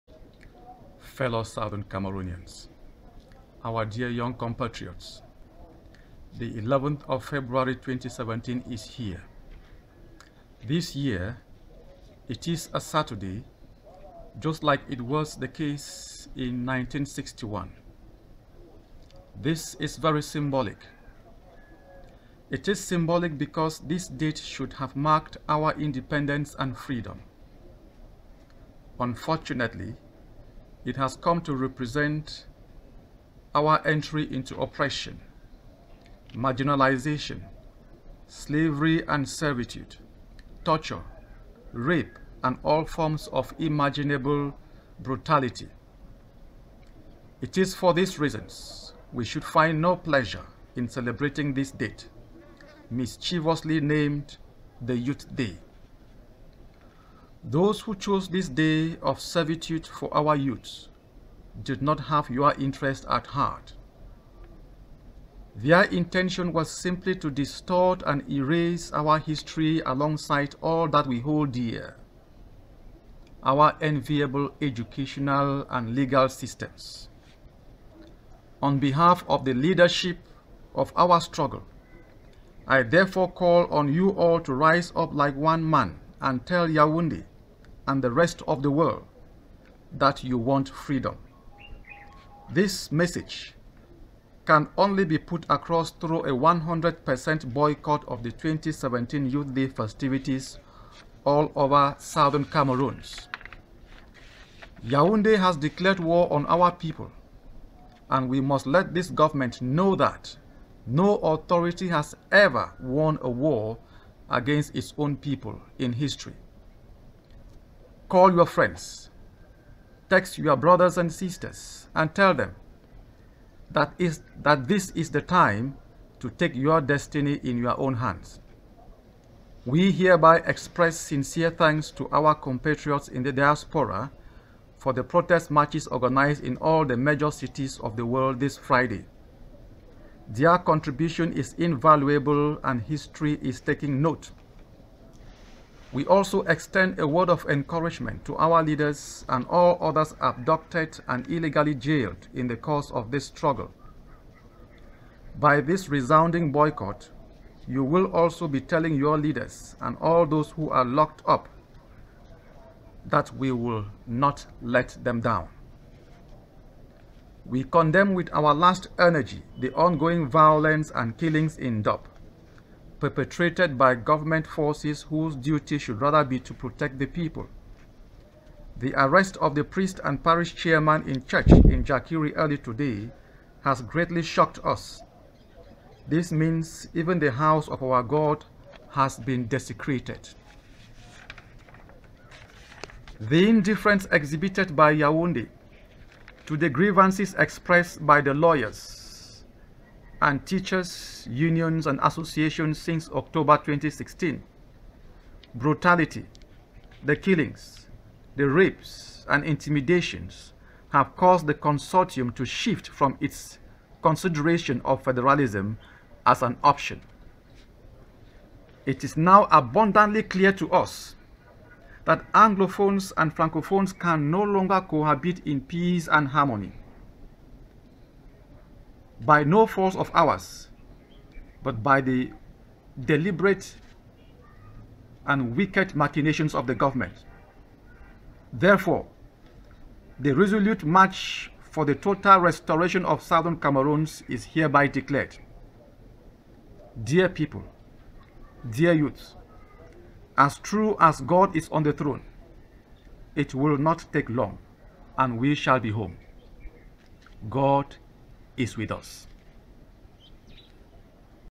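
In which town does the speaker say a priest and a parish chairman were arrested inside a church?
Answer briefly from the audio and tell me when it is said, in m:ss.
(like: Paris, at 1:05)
Jakiri, at 3:01.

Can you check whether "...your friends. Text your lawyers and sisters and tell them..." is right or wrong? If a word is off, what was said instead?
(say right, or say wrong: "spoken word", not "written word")
wrong: "brothers", not "lawyers".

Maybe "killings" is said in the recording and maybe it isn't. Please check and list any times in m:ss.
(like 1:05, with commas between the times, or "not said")
2:51, 3:27.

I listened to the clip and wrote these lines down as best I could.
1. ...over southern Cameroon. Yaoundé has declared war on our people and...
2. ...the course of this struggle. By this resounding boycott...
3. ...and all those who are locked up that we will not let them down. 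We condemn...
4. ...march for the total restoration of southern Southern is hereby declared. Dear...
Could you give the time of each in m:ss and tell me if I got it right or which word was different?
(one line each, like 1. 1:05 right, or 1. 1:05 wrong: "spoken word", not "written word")
1. 1:41 right
2. 2:32 right
3. 2:39 right
4. 4:00 wrong: "Cameroons", not "Southern".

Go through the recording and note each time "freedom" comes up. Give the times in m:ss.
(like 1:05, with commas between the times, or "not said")
0:26, 1:30.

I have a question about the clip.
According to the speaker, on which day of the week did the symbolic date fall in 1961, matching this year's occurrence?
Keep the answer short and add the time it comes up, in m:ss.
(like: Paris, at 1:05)
Saturday, at 0:12.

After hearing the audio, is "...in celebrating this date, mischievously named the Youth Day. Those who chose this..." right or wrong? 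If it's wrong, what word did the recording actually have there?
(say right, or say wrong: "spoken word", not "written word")
right.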